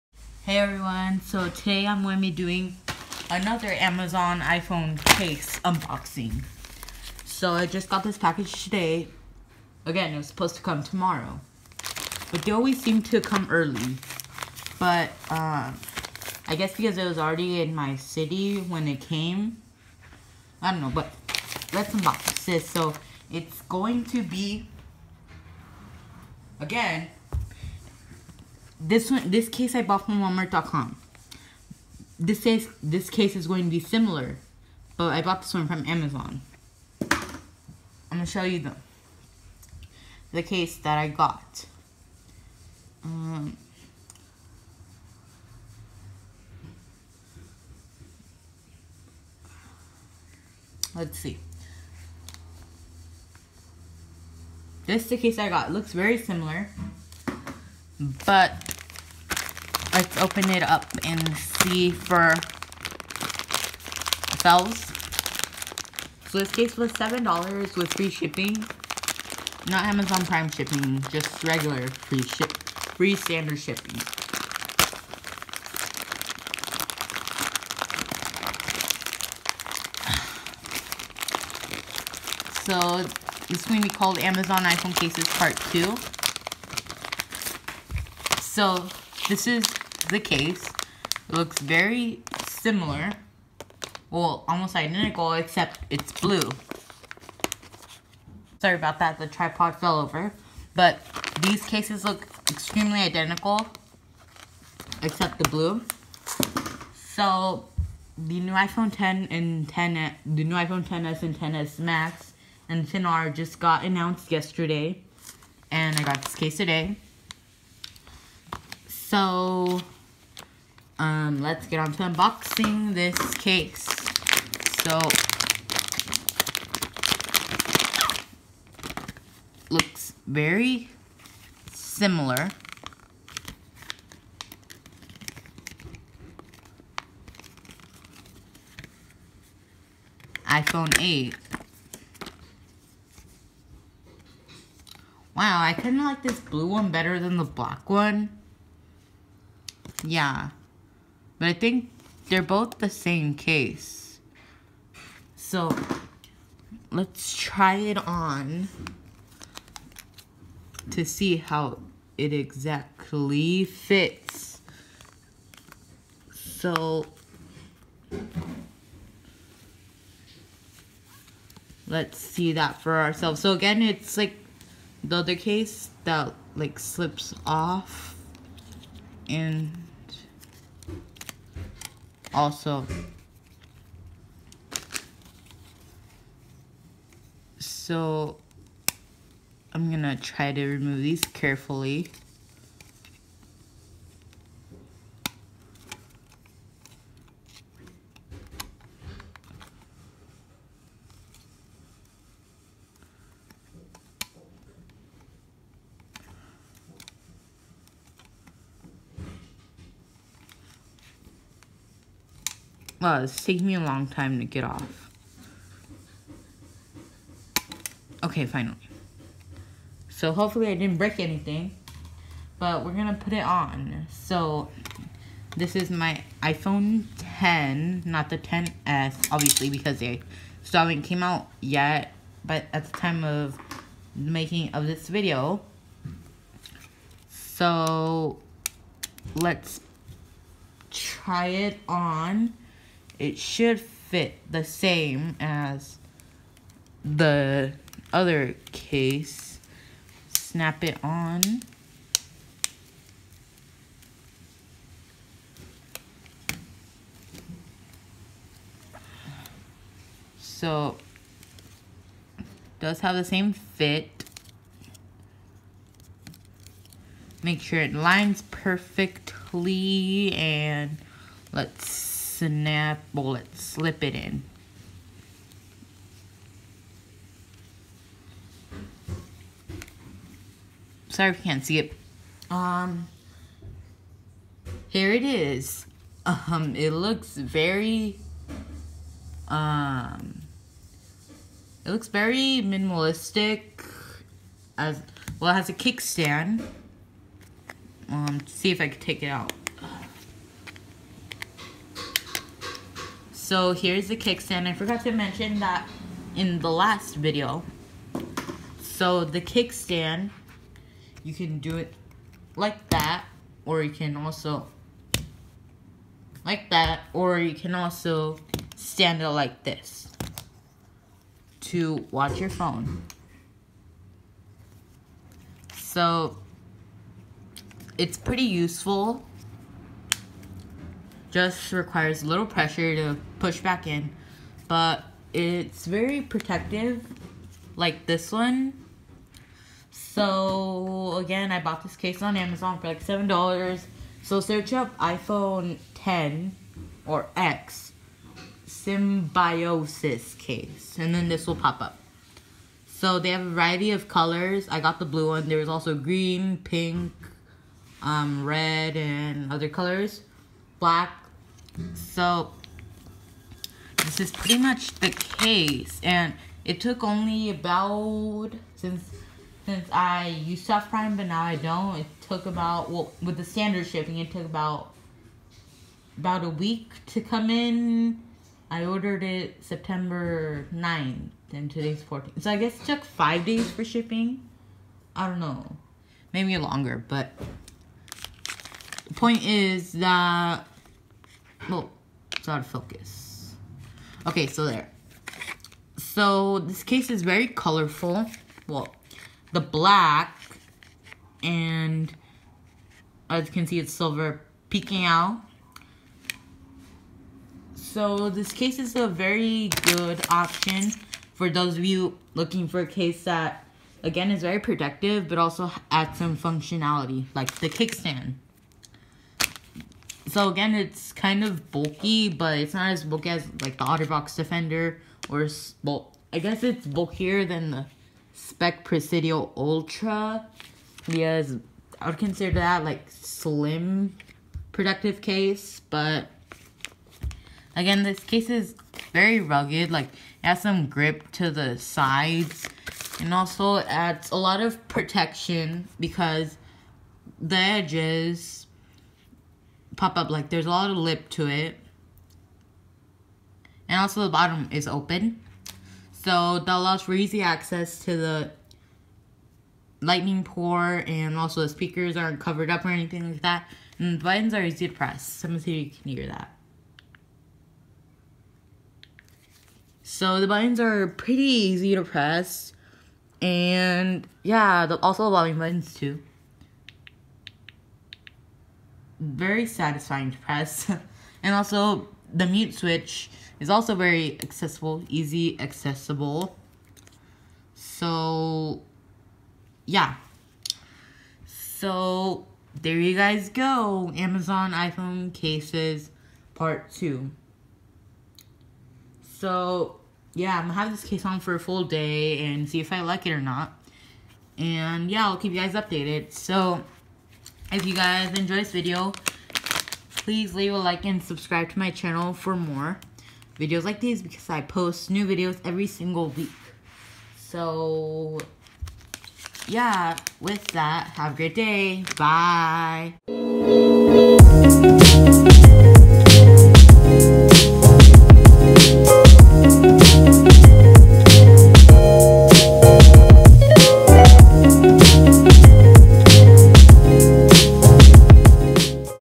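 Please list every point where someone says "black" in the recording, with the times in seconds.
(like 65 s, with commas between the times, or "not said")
147 s, 360 s, 399 s.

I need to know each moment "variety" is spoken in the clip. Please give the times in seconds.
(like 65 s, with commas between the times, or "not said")
353 s.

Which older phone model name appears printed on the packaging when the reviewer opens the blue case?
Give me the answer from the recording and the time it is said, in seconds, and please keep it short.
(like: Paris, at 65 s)
iPhone 8, at 140 s.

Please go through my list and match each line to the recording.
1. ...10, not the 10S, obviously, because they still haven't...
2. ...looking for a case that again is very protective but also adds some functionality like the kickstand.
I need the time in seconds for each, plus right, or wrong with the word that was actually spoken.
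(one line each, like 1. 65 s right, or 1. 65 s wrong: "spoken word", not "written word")
1. 227 s right
2. 412 s right.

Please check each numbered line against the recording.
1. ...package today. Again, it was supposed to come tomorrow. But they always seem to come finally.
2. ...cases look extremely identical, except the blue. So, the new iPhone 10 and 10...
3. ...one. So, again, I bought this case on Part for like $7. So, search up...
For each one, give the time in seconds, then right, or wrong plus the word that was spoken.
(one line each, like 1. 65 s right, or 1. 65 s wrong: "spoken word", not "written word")
1. 8 s wrong: "early", not "finally"
2. 101 s right
3. 338 s wrong: "Amazon", not "Part".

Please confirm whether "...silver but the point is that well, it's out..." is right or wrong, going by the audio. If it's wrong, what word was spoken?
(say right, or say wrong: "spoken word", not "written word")
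wrong: "longer", not "silver".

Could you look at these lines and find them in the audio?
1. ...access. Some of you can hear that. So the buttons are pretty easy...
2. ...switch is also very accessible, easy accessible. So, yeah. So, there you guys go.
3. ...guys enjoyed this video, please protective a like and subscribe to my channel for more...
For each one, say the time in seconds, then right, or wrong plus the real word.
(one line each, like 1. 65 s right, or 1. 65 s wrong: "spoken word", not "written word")
1. 464 s wrong: "press", not "access"
2. 482 s right
3. 507 s wrong: "leave", not "protective".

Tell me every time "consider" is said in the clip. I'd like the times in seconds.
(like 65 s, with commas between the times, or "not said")
432 s.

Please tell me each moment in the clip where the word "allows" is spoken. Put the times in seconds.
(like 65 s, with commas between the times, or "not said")
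456 s.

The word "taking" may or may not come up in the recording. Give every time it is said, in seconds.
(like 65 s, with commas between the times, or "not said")
213 s.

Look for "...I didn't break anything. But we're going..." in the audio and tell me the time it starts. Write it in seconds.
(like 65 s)
220 s.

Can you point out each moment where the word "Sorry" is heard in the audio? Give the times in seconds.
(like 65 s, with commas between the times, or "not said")
98 s, 281 s.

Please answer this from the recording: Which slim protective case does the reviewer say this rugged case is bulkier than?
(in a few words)
Speck Presidio Ultra.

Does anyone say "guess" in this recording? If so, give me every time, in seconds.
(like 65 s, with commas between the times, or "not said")
16 s, 382 s, 426 s.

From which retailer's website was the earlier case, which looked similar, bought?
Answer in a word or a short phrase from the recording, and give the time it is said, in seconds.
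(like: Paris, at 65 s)
Walmart.com, at 30 s.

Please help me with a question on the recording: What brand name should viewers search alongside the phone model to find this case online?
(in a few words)
symbiosis.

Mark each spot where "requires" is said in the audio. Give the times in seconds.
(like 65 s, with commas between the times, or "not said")
331 s.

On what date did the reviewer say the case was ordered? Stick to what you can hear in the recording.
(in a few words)
September 9th.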